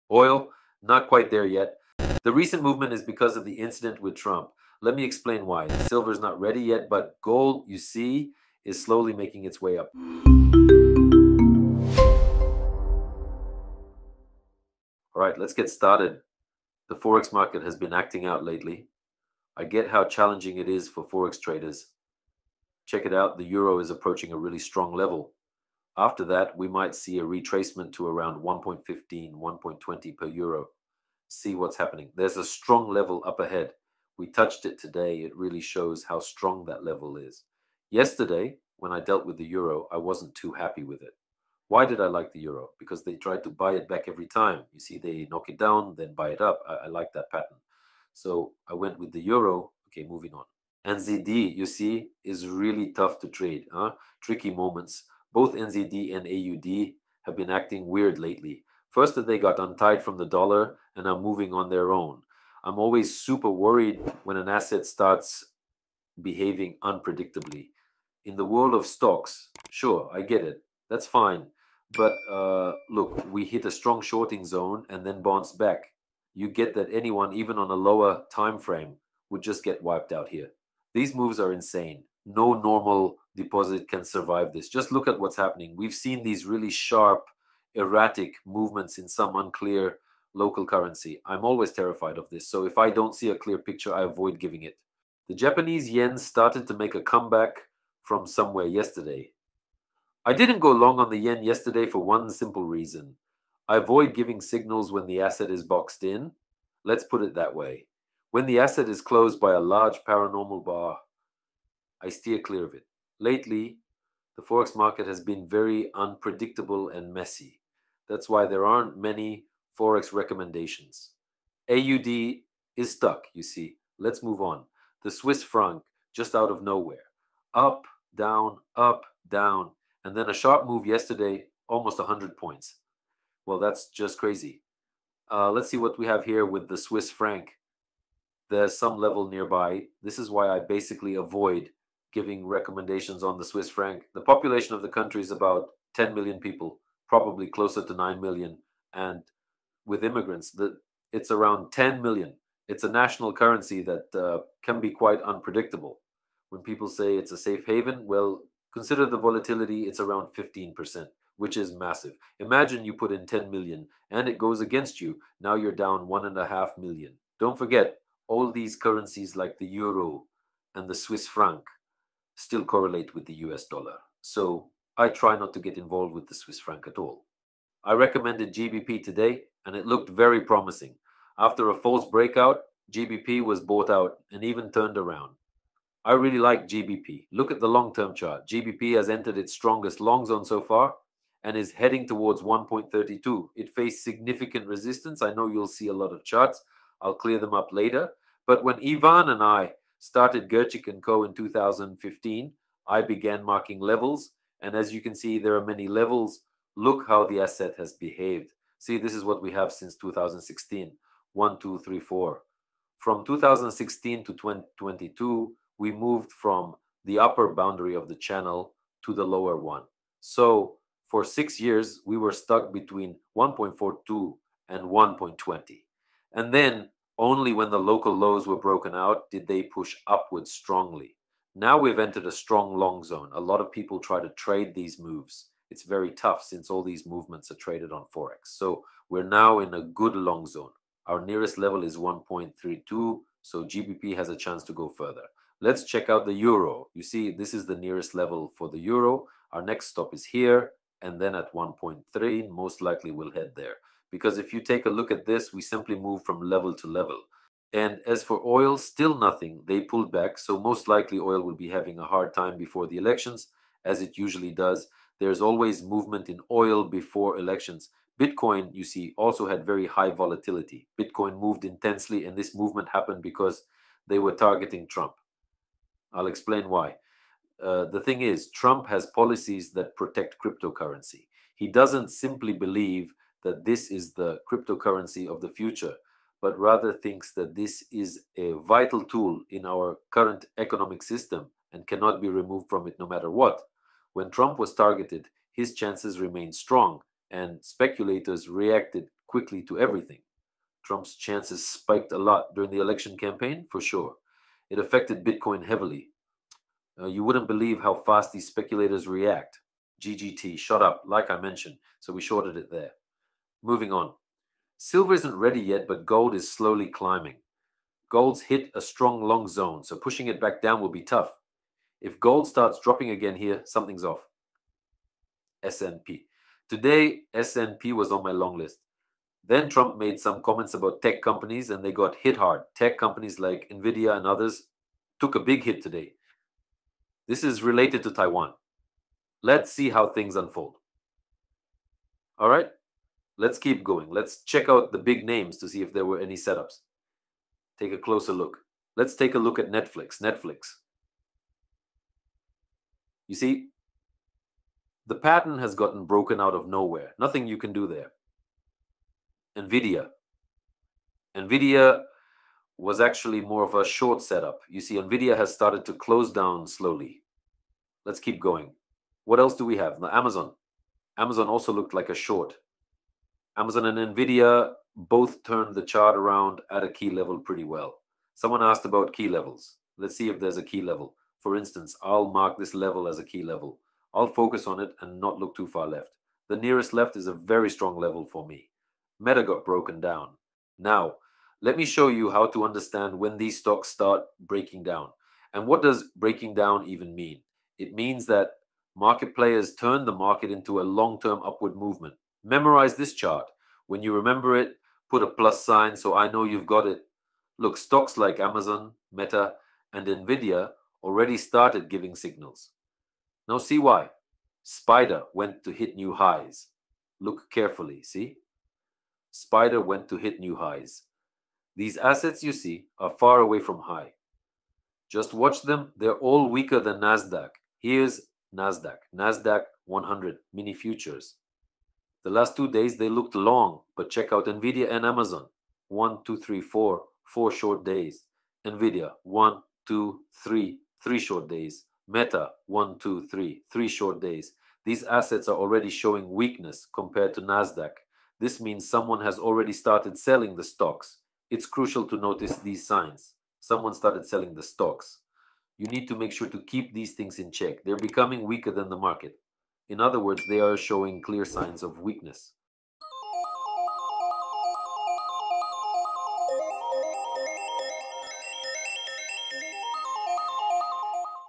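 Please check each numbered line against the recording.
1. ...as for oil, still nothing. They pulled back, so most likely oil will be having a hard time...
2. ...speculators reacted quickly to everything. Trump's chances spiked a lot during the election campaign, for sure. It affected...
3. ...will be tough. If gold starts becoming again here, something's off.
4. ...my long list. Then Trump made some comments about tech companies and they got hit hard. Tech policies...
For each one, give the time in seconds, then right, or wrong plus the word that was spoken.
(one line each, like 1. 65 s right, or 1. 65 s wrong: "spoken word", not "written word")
1. 258 s right
2. 297 s right
3. 320 s wrong: "dropping", not "becoming"
4. 328 s wrong: "companies", not "policies".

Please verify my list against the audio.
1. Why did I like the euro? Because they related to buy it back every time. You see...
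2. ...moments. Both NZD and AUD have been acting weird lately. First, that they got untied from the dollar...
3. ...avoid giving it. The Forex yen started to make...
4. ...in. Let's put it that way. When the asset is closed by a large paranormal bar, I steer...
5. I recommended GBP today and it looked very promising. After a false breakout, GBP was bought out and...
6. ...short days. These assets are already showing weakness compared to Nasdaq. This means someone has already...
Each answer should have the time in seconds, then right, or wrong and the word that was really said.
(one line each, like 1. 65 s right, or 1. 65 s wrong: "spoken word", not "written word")
1. 41 s wrong: "tried", not "related"
2. 54 s right
3. 94 s wrong: "Japanese", not "Forex"
4. 106 s right
5. 177 s right
6. 443 s right.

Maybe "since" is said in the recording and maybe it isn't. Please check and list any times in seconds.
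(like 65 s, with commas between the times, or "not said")
209 s, 236 s.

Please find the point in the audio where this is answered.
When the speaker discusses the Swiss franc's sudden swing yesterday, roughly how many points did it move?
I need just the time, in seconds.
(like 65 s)
131 s.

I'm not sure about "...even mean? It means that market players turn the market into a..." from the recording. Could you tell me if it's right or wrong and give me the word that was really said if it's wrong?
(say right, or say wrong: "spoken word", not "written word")
right.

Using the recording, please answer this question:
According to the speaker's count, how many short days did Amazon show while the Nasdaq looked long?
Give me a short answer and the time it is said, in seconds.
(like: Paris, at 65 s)
4, at 437 s.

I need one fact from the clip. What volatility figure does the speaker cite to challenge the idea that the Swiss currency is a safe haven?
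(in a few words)
15%.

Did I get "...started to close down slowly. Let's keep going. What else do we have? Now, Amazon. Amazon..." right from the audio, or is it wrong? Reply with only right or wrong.
right.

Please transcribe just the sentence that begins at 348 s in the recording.
Let's take a look at Netflix.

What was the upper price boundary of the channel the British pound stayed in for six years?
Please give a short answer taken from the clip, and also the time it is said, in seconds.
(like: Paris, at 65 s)
1.42, at 223 s.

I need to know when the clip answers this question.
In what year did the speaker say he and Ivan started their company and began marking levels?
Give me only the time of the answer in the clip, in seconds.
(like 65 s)
201 s.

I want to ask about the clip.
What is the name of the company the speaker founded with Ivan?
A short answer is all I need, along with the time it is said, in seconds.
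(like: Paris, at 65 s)
Gerchik and Co., at 200 s.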